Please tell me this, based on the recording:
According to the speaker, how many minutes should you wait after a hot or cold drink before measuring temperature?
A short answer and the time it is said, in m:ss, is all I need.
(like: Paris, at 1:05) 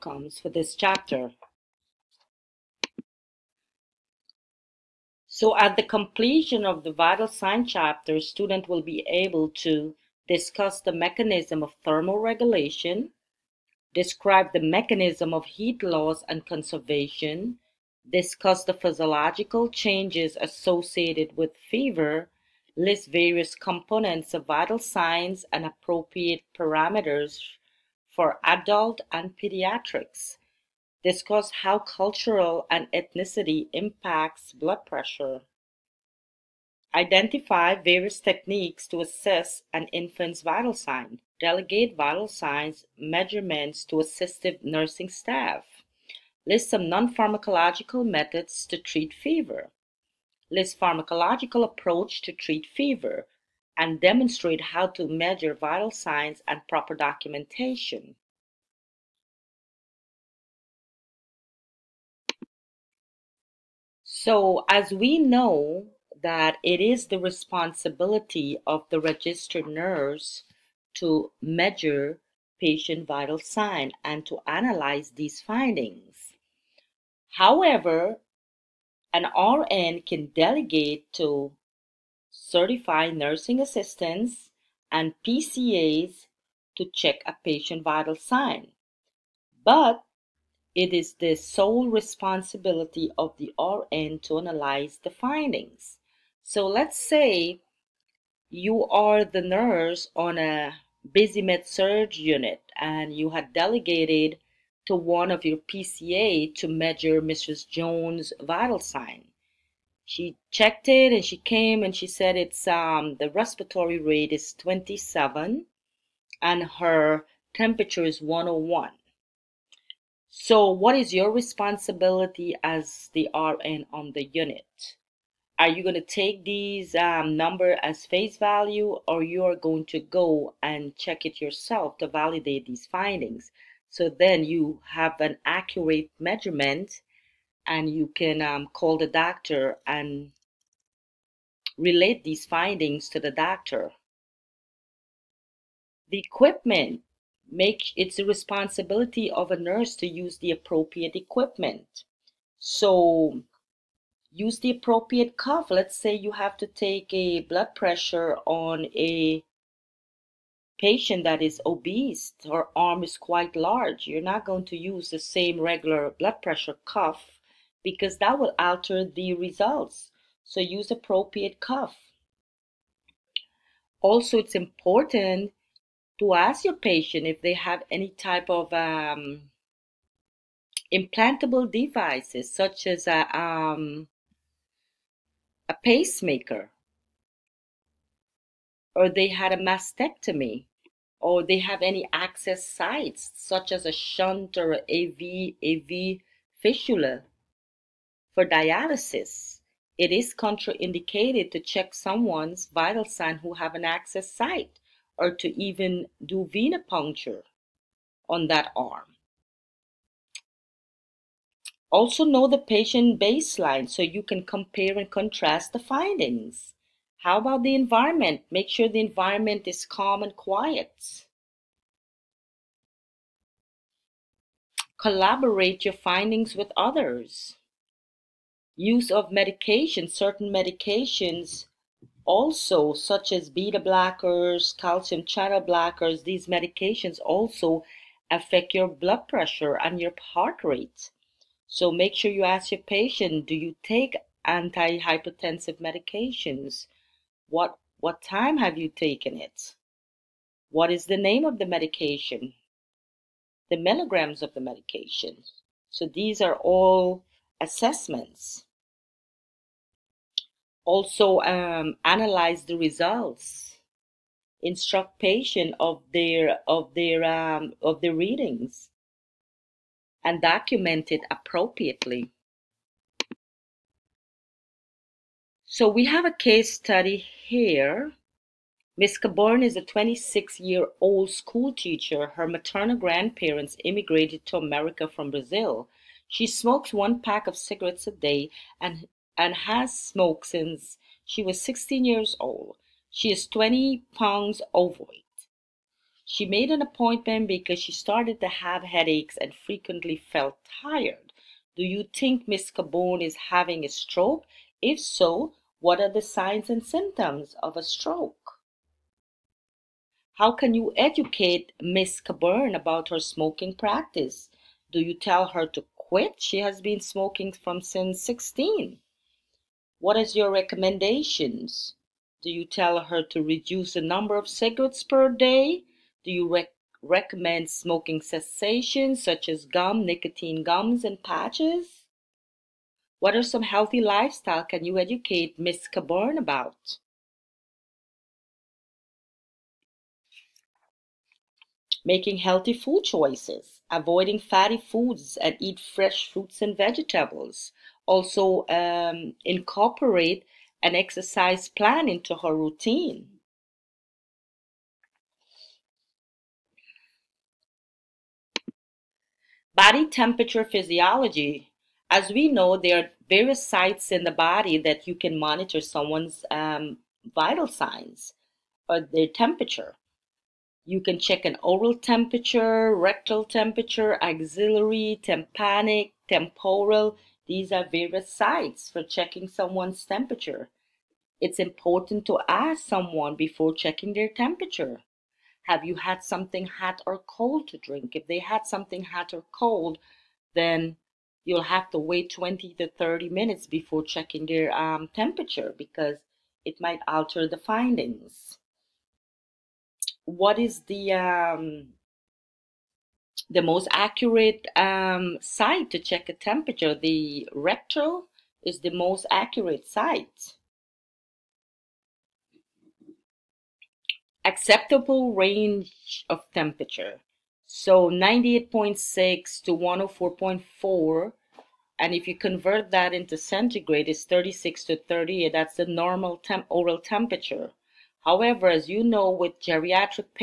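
20 to 30, at 6:32.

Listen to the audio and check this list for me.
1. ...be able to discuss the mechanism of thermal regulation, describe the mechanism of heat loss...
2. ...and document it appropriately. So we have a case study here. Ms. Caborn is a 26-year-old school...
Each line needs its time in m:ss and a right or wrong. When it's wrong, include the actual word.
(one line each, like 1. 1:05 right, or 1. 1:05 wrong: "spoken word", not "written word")
1. 0:08 right
2. 4:30 right.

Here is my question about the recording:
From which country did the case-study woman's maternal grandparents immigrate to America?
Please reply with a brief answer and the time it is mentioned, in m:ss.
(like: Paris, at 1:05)
Brazil, at 4:45.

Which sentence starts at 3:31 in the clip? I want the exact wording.
Also know the patient baseline so you can compare and contrast the findings.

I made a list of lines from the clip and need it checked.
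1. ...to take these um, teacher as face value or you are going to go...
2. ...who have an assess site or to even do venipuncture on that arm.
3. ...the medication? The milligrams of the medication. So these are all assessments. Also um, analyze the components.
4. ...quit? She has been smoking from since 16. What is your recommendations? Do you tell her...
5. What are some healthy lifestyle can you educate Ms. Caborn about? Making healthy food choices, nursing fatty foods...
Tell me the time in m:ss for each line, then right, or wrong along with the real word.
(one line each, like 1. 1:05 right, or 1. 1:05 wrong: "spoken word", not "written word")
1. 2:05 wrong: "number", not "teacher"
2. 3:23 wrong: "access", not "assess"
3. 4:11 wrong: "results", not "components"
4. 5:15 right
5. 5:33 wrong: "avoiding", not "nursing".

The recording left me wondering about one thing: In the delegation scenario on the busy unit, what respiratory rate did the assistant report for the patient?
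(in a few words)
27.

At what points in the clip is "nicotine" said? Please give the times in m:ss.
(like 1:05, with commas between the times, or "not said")
5:30.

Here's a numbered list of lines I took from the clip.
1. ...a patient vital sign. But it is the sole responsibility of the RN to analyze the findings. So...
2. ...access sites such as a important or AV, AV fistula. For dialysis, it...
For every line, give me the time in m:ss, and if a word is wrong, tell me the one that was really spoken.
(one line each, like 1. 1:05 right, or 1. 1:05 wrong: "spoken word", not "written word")
1. 1:27 right
2. 3:12 wrong: "shunt", not "important".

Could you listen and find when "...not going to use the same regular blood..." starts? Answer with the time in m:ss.
2:44.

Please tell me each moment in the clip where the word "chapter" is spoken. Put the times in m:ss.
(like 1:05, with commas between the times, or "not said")
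0:00, 0:07.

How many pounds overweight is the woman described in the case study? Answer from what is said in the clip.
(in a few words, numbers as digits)
20.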